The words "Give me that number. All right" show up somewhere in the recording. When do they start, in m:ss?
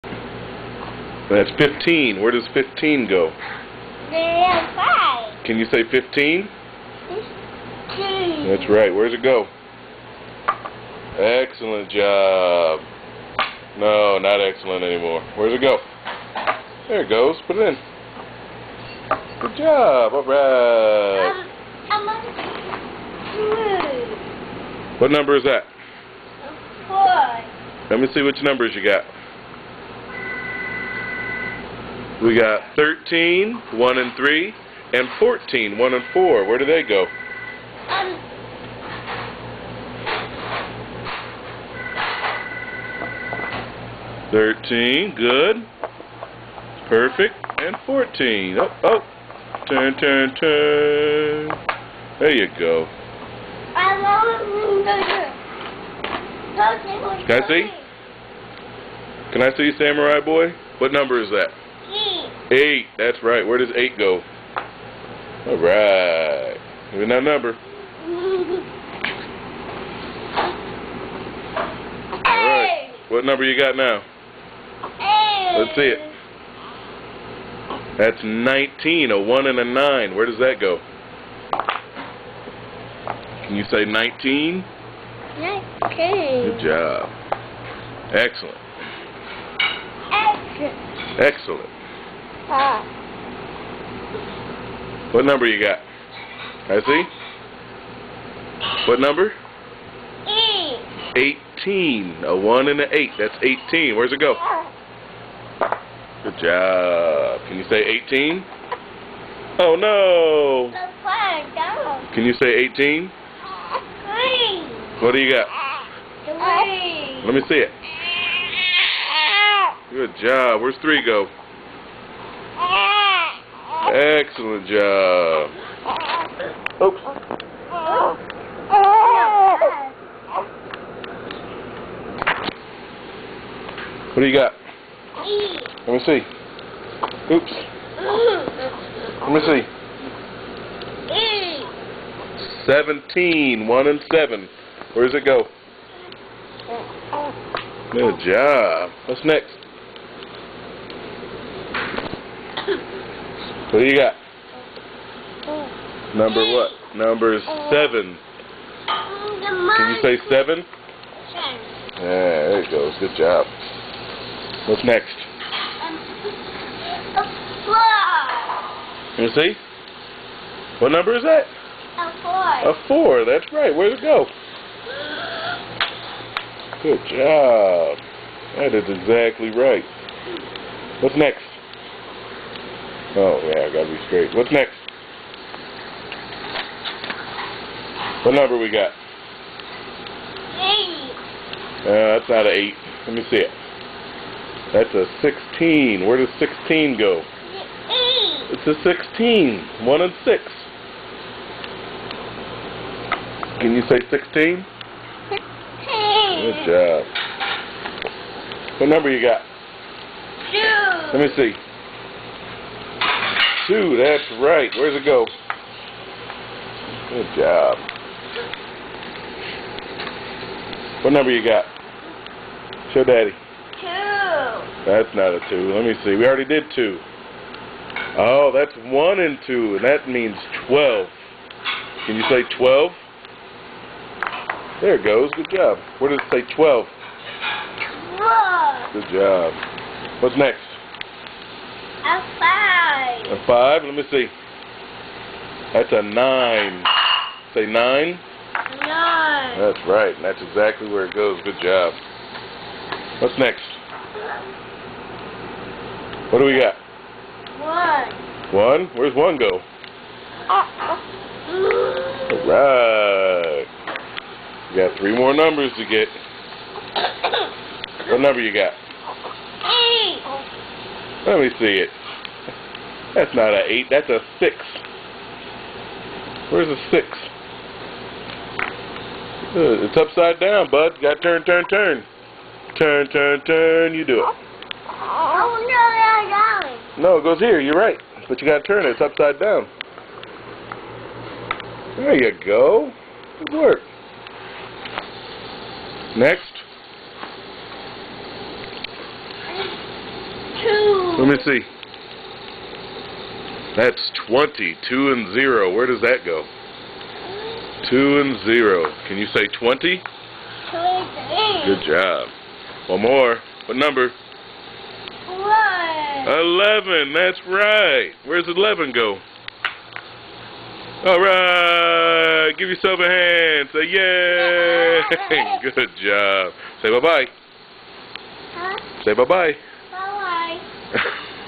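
1:06.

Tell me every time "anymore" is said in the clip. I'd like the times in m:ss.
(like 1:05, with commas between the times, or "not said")
0:14.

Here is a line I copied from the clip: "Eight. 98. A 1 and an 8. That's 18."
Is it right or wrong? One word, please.
wrong.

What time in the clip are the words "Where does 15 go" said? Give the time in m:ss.
0:02.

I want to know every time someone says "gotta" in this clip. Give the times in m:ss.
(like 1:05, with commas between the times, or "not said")
3:03, 4:41, 4:48.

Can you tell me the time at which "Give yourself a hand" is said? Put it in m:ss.
5:22.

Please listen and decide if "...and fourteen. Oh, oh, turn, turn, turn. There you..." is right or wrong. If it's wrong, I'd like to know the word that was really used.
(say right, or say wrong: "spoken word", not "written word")
right.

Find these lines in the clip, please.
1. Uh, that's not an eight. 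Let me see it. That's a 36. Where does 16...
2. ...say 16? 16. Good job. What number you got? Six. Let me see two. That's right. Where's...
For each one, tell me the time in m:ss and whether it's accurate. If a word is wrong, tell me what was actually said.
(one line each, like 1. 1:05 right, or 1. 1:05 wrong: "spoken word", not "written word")
1. 3:11 wrong: "16", not "36"
2. 3:23 wrong: "Two", not "Six".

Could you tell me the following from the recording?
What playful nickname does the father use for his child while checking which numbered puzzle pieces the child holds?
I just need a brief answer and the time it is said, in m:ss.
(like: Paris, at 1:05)
Samurai Boy, at 0:59.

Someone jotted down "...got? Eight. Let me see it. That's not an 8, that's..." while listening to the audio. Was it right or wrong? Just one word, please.
right.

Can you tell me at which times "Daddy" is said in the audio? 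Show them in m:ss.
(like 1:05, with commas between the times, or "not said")
3:43.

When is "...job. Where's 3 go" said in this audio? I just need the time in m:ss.
2:00.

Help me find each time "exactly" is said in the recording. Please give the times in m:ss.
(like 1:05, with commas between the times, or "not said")
2:58, 4:10.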